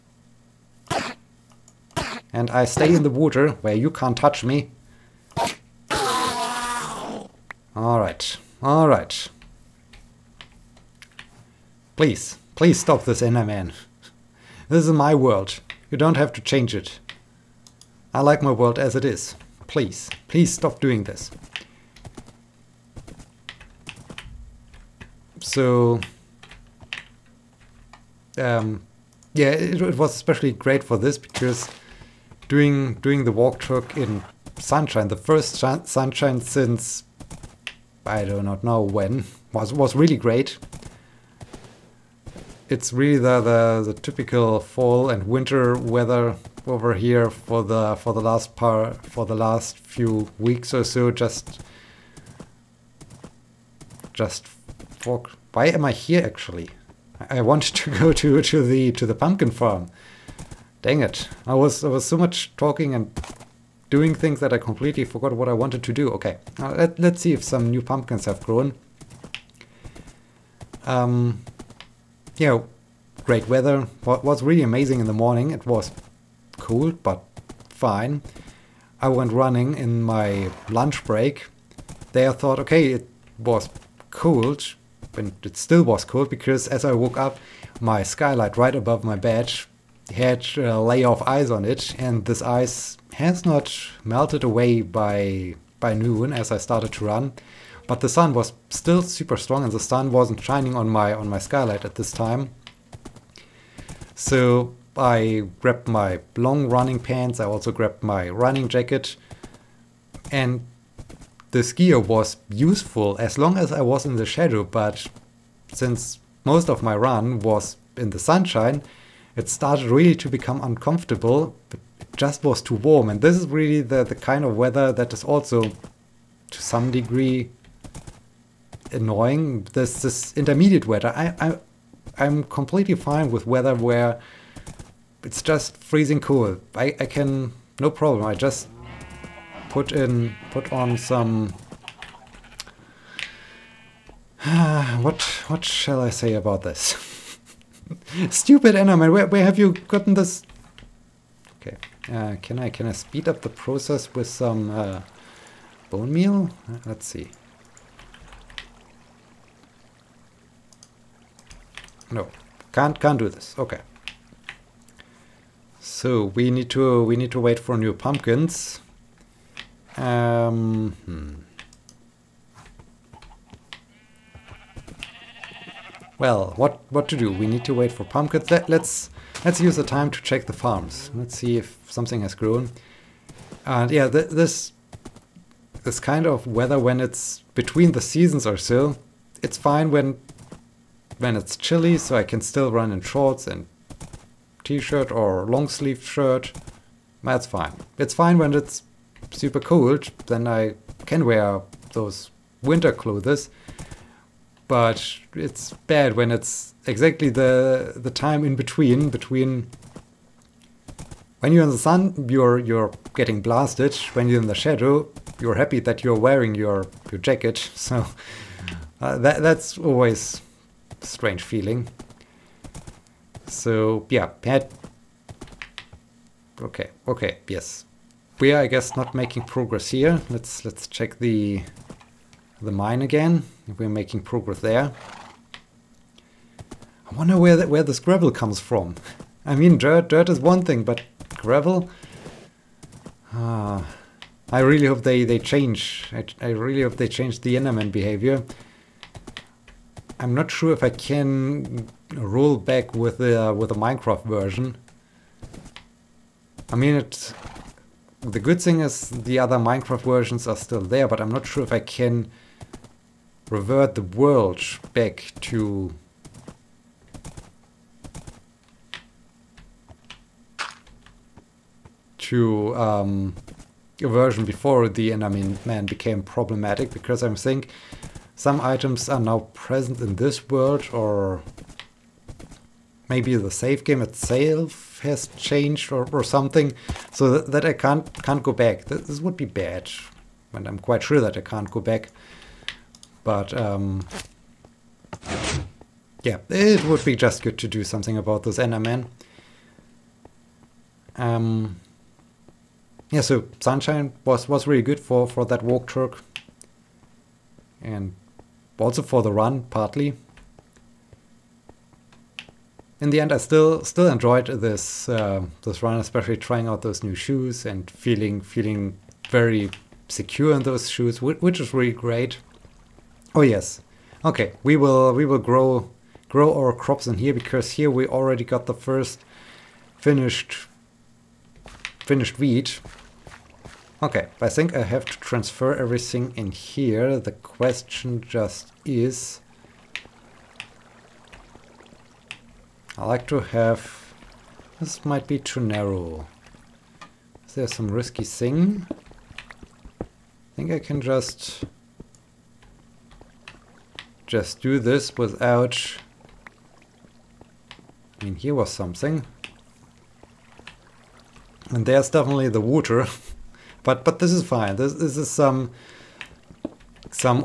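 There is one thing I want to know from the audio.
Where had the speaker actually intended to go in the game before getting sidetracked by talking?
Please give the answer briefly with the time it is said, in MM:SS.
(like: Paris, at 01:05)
the pumpkin farm, at 00:59.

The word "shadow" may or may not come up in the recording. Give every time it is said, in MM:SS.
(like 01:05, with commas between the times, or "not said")
01:54, 03:34.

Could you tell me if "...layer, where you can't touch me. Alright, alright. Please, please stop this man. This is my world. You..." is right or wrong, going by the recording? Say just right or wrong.
wrong.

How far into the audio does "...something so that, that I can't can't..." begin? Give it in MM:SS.
04:46.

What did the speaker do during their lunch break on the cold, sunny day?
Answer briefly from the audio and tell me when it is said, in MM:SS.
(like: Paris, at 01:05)
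went running, at 01:19.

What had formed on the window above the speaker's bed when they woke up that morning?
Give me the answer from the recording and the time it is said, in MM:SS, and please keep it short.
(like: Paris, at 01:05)
a layer of ice, at 01:30.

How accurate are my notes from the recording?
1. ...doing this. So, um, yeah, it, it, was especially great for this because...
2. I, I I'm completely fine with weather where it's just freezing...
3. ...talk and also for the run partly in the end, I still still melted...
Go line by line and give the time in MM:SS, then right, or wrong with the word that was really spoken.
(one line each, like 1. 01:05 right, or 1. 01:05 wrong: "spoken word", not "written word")
1. 00:20 right
2. 02:11 right
3. 05:05 wrong: "enjoyed", not "melted".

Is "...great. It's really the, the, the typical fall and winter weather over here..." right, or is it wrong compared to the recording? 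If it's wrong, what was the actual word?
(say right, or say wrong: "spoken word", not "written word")
right.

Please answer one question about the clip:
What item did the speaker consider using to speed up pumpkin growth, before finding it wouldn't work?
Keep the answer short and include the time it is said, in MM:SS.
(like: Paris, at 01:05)
bone meal, at 02:35.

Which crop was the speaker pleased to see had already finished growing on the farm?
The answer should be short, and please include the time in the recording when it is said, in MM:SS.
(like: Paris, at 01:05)
wheat, at 05:32.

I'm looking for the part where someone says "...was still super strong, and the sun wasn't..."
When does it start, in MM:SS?
01:38.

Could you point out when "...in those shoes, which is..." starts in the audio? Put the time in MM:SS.
05:20.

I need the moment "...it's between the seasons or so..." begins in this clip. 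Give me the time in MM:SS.
03:07.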